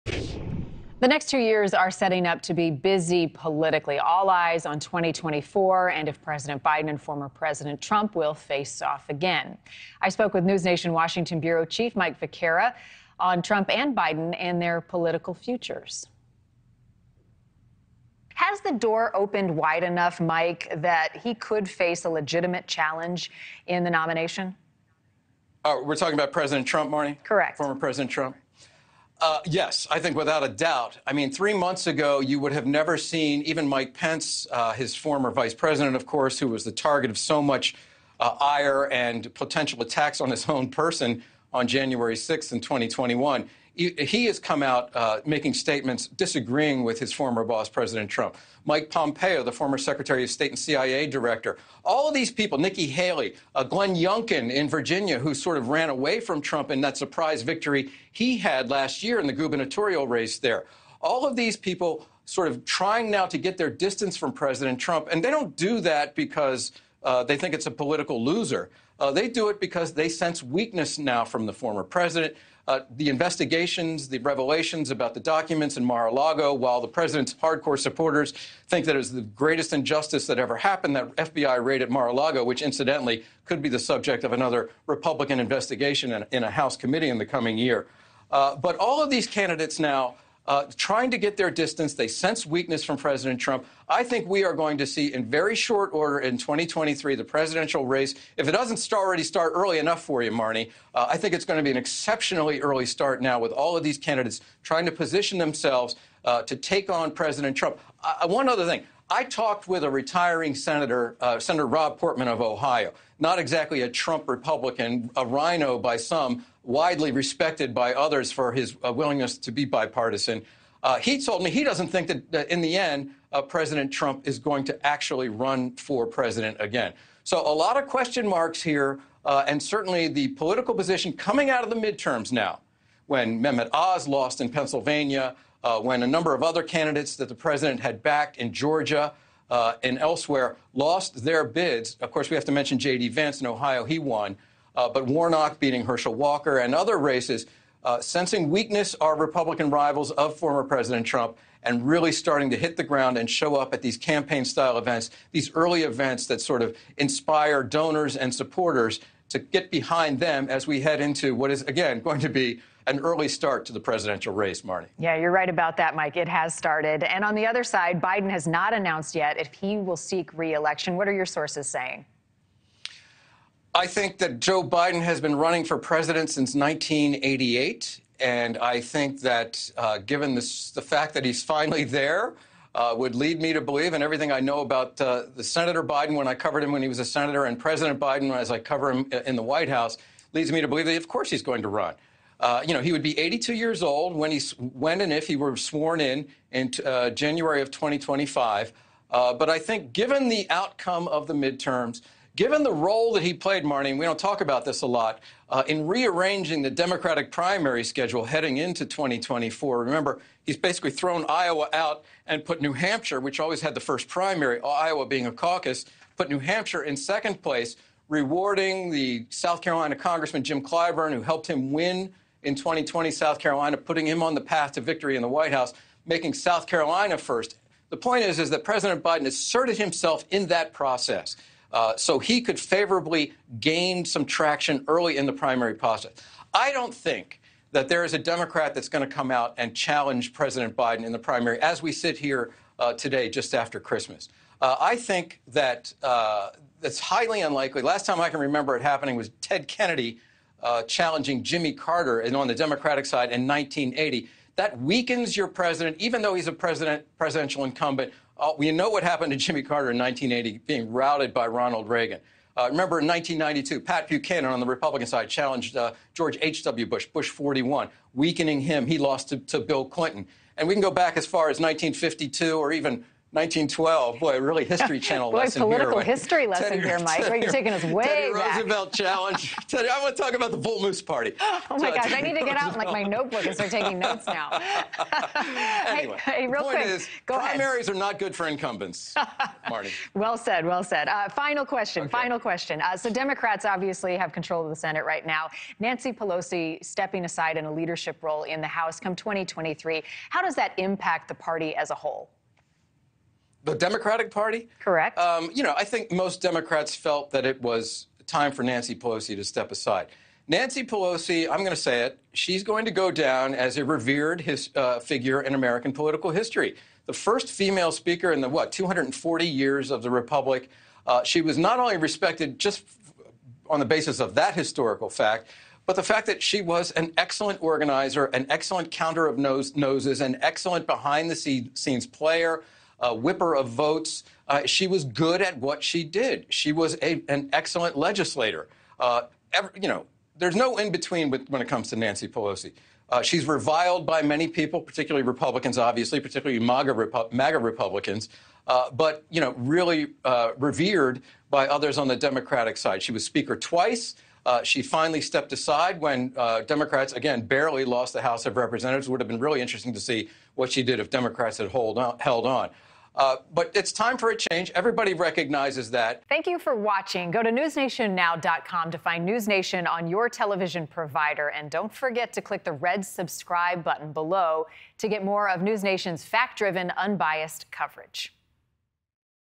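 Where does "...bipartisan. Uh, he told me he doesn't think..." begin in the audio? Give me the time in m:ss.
1:59.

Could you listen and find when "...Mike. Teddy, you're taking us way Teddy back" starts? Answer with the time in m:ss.
4:36.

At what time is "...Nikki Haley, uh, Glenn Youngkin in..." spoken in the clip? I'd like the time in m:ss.
0:52.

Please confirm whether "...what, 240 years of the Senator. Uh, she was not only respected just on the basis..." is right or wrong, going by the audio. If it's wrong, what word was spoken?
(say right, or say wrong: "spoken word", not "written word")
wrong: "Republic", not "Senator".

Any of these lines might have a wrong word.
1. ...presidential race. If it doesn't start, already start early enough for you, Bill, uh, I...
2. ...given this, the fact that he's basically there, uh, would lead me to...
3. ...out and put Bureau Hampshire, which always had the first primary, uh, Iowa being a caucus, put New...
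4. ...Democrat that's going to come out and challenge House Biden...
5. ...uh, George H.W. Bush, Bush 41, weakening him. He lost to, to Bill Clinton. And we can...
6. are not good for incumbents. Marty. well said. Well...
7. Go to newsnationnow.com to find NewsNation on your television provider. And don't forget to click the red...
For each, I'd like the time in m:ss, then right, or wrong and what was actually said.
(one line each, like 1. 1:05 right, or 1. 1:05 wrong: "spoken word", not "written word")
1. 1:37 wrong: "Marni", not "Bill"
2. 2:59 wrong: "finally", not "basically"
3. 3:31 wrong: "New", not "Bureau"
4. 3:58 wrong: "President", not "House"
5. 4:25 right
6. 4:47 right
7. 6:07 right.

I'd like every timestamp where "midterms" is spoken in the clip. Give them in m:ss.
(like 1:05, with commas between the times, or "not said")
2:11, 3:21.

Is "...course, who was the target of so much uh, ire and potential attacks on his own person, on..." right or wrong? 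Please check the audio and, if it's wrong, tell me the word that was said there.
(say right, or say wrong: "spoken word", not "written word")
right.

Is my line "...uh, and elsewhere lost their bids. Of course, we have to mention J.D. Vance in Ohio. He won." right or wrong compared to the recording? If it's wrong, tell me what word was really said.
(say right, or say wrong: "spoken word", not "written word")
right.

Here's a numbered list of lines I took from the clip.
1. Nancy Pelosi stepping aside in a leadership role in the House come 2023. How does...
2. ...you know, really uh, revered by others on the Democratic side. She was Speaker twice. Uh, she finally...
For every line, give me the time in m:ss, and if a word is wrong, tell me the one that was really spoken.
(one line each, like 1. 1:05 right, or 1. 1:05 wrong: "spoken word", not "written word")
1. 4:55 right
2. 5:49 right.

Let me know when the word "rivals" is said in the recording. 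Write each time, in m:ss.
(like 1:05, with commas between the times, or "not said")
2:29.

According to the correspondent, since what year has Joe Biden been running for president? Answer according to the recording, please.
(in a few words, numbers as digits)
1988.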